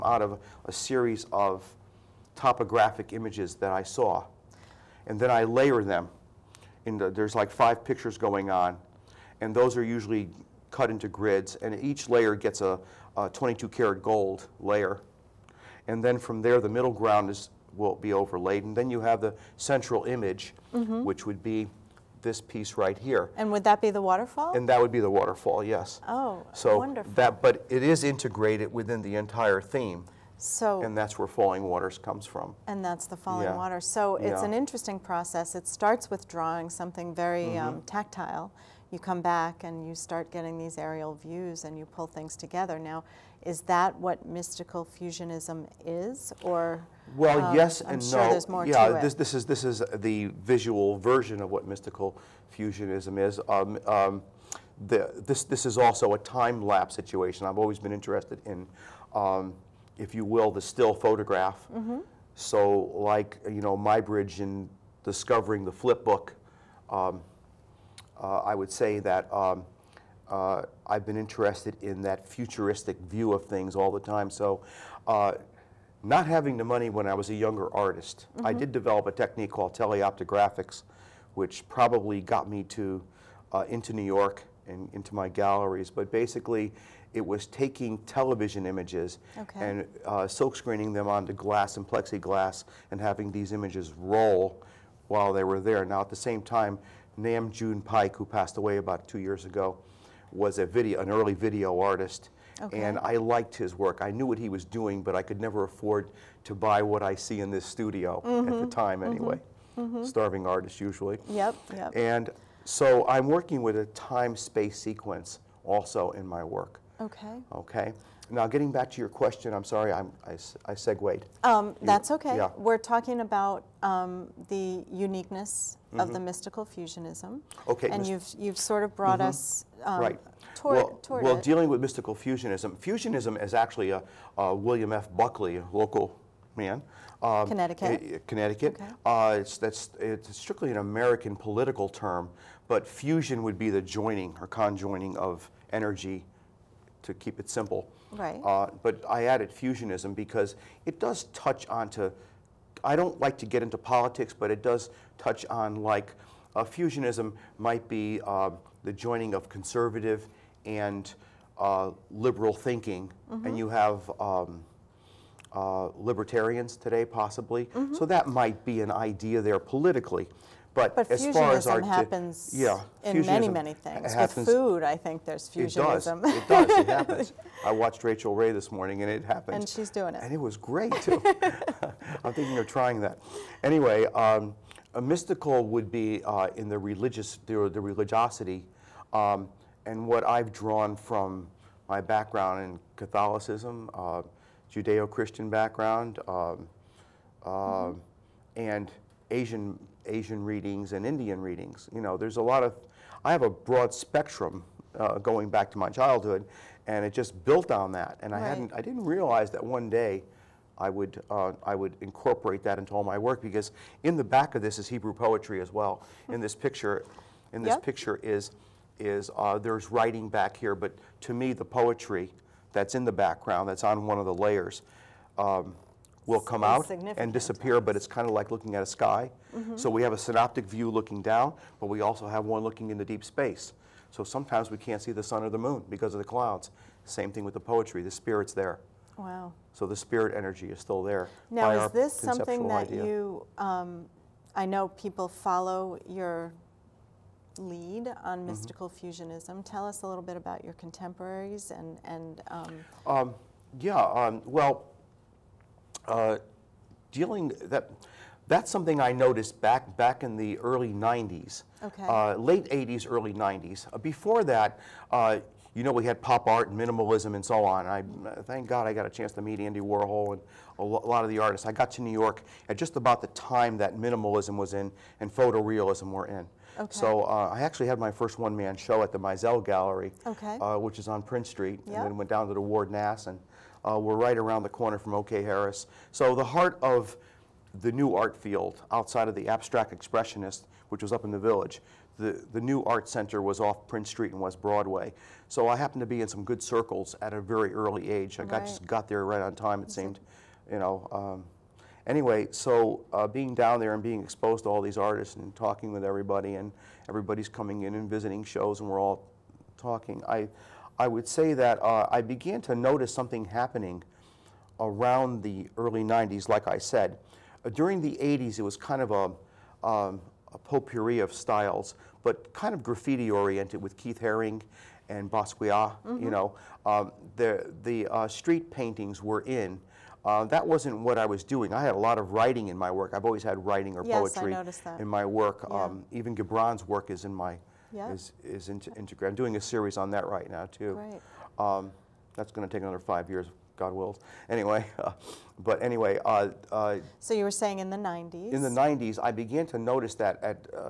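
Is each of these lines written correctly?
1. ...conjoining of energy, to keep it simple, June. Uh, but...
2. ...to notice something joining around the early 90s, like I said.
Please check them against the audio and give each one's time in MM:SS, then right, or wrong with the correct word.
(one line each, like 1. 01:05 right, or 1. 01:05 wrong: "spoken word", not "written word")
1. 02:24 wrong: "Right", not "June"
2. 05:12 wrong: "happening", not "joining".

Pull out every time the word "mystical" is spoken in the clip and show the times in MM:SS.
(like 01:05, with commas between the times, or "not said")
00:44, 00:51, 02:06, 02:11, 03:05, 04:08.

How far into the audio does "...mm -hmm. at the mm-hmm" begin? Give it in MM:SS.
01:48.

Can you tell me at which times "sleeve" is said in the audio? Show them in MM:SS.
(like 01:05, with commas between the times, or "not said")
not said.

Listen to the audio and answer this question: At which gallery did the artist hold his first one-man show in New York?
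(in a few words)
Meisel Gallery.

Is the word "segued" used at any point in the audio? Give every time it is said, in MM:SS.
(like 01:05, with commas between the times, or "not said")
02:00.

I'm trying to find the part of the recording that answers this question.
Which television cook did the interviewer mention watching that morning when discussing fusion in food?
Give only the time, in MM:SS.
02:58.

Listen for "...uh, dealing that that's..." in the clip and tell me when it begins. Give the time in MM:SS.
04:16.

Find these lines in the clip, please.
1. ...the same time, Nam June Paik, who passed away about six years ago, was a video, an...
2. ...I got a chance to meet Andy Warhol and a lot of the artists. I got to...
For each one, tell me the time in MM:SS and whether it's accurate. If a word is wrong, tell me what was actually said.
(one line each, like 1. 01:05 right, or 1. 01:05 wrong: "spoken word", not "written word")
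1. 01:36 wrong: "two", not "six"
2. 04:28 right.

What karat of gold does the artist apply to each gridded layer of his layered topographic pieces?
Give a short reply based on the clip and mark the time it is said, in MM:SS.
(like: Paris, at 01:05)
22, at 00:13.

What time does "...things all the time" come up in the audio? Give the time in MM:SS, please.
01:13.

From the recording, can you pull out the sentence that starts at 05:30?
Uh, that wasn't what I was doing.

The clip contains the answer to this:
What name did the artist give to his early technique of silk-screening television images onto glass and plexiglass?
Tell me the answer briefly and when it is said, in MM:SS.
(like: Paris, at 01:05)
teleoptographics, at 01:19.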